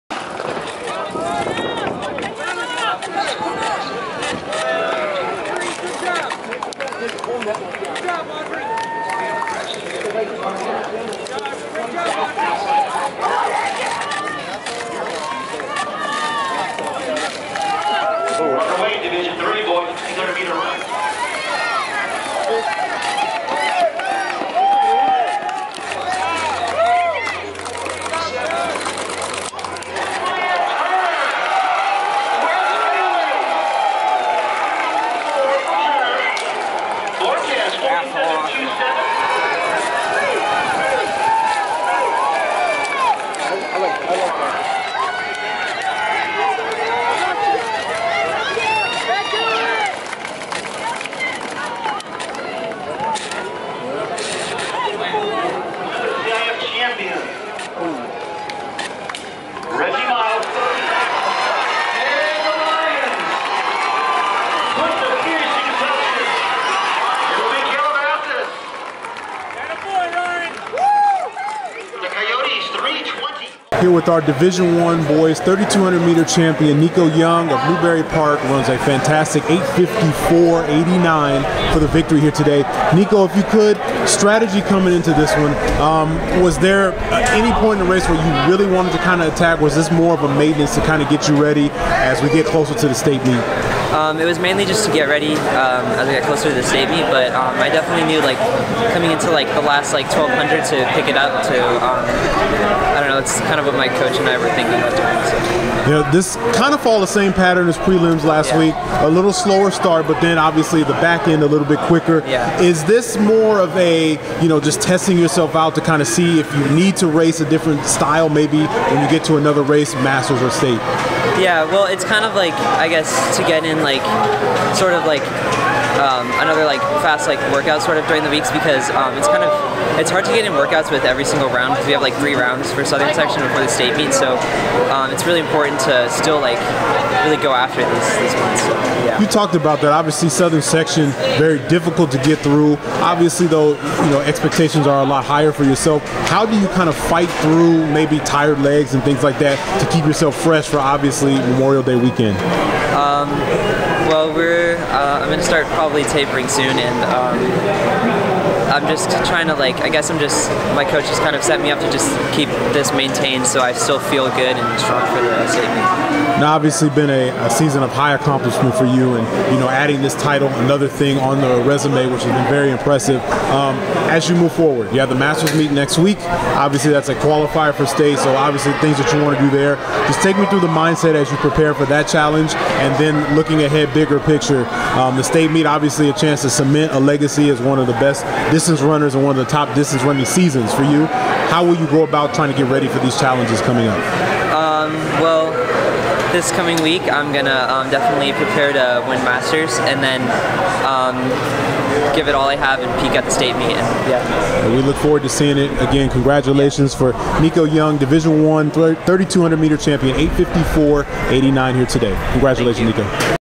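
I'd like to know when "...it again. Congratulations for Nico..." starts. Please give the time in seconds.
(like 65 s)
205 s.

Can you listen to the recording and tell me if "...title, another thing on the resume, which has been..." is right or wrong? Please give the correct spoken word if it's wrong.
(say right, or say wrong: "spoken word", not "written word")
right.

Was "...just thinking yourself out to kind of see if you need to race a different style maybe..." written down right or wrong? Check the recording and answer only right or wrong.
wrong.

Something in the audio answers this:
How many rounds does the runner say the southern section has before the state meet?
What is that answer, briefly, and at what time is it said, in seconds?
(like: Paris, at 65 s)
3, at 132 s.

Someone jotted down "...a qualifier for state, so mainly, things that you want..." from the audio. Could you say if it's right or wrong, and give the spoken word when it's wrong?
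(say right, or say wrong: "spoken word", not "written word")
wrong: "obviously", not "mainly".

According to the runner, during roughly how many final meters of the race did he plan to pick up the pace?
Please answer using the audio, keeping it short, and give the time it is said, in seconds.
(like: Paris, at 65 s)
1200, at 100 s.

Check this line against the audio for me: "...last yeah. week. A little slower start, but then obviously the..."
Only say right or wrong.
right.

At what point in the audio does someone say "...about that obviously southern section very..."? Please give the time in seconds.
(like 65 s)
139 s.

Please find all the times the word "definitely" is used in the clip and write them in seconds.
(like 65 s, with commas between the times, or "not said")
97 s, 197 s.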